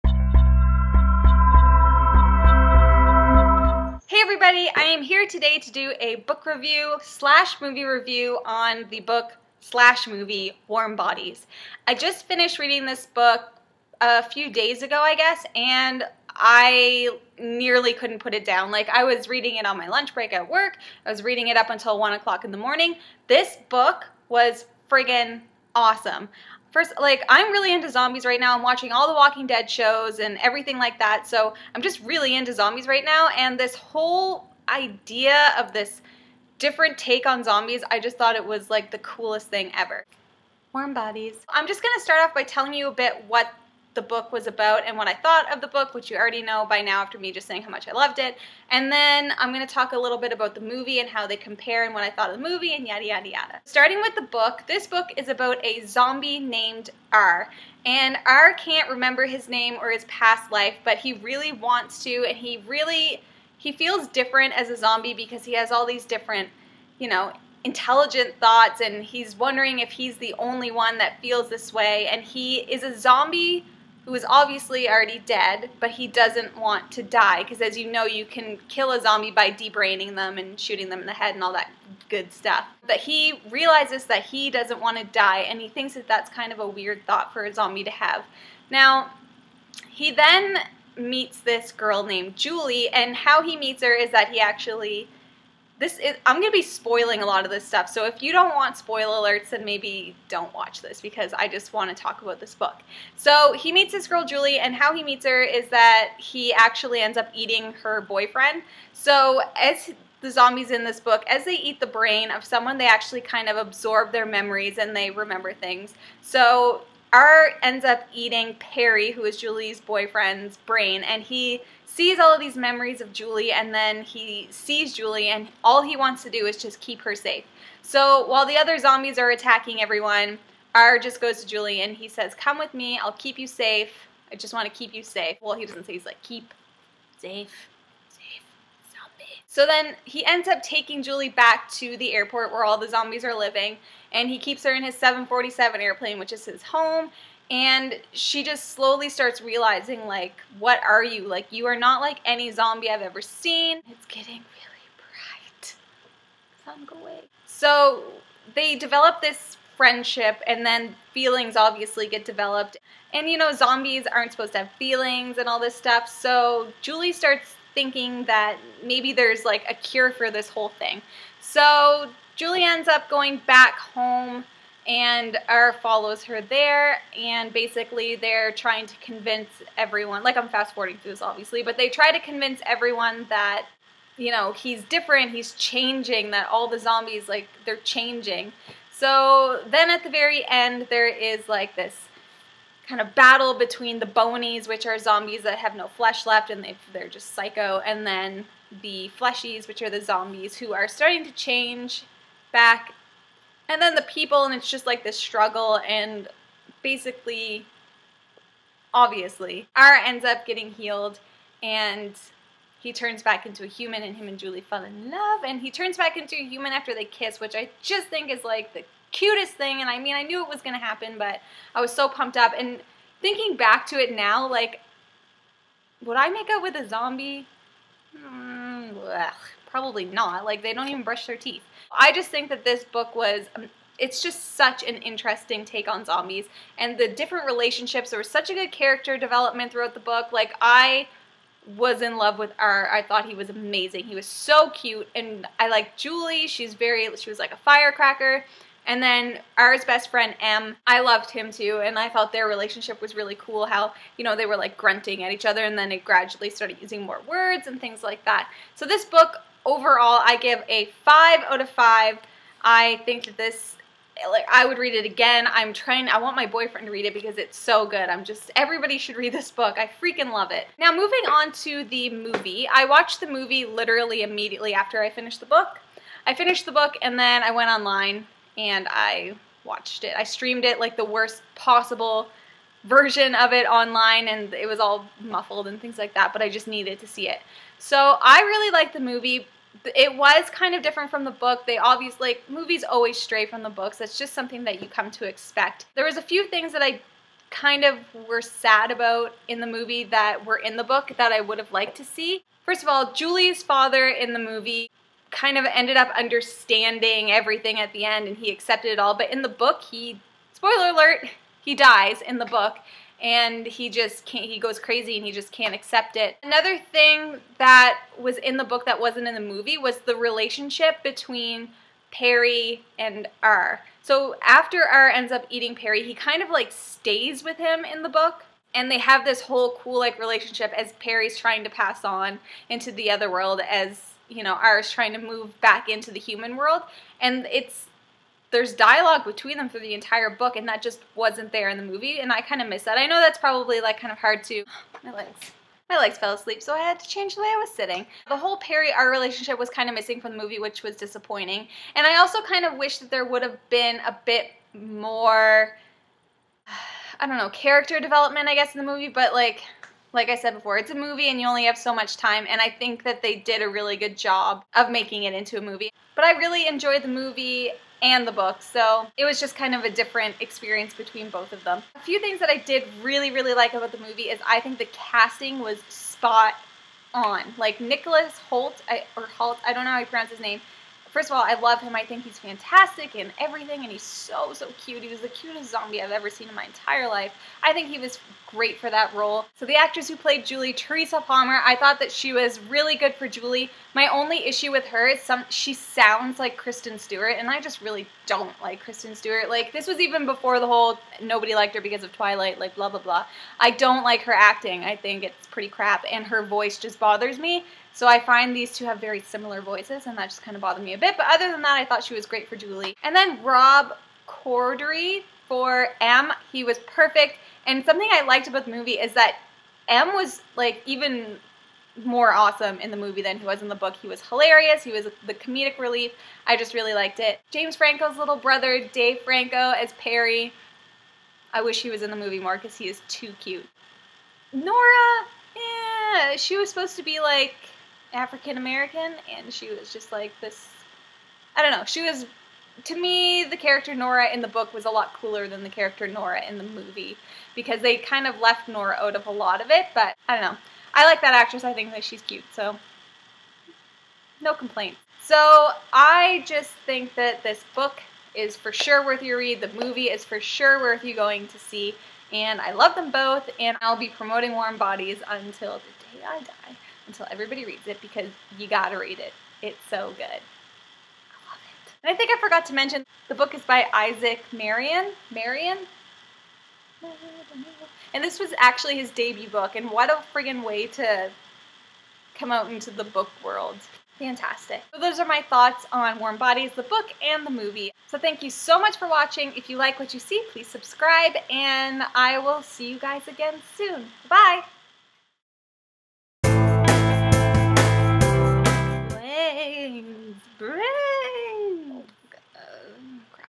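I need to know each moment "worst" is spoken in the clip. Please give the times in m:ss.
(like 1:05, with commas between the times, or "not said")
4:41.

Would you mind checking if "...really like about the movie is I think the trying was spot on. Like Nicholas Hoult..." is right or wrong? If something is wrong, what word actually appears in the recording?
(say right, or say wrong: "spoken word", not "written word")
wrong: "casting", not "trying".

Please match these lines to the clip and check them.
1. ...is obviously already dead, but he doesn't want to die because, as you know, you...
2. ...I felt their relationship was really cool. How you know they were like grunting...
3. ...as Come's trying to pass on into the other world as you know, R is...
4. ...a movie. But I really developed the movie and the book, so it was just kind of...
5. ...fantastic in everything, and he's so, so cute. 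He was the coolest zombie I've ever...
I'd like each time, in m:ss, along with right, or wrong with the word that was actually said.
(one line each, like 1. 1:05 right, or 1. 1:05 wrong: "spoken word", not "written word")
1. 1:14 right
2. 4:11 right
3. 5:30 wrong: "Perry", not "Come"
4. 6:05 wrong: "enjoyed", not "developed"
5. 6:22 wrong: "cutest", not "coolest".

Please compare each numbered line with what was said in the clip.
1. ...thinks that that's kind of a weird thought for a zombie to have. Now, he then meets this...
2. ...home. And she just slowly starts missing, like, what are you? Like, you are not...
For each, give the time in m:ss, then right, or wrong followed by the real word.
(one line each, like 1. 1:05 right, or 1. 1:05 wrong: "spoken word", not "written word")
1. 1:25 right
2. 2:26 wrong: "realizing", not "missing".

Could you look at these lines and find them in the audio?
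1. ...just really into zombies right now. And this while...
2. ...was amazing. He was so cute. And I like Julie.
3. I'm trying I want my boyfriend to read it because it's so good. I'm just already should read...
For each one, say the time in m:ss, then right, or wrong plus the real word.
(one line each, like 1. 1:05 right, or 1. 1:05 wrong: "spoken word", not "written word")
1. 0:31 wrong: "whole", not "while"
2. 4:03 right
3. 4:25 wrong: "everybody", not "already".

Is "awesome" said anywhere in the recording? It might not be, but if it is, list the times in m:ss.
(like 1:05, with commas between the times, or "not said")
0:25, 7:02.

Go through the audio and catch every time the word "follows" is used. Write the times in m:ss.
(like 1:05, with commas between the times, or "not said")
2:55.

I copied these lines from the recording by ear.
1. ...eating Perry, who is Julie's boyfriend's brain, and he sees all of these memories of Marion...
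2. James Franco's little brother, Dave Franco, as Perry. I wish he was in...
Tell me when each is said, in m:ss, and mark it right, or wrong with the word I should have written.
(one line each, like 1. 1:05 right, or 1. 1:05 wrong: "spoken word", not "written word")
1. 1:58 wrong: "Julie", not "Marion"
2. 7:07 right.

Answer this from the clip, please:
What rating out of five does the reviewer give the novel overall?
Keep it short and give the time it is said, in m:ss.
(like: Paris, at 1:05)
five out of five, at 4:21.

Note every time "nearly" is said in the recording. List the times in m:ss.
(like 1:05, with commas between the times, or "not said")
0:17.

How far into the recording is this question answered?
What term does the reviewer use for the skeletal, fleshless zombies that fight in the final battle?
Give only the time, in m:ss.
3:14.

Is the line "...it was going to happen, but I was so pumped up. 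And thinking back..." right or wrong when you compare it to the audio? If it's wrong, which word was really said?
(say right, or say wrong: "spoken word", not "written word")
right.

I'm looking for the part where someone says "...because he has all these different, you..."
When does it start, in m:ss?
1:05.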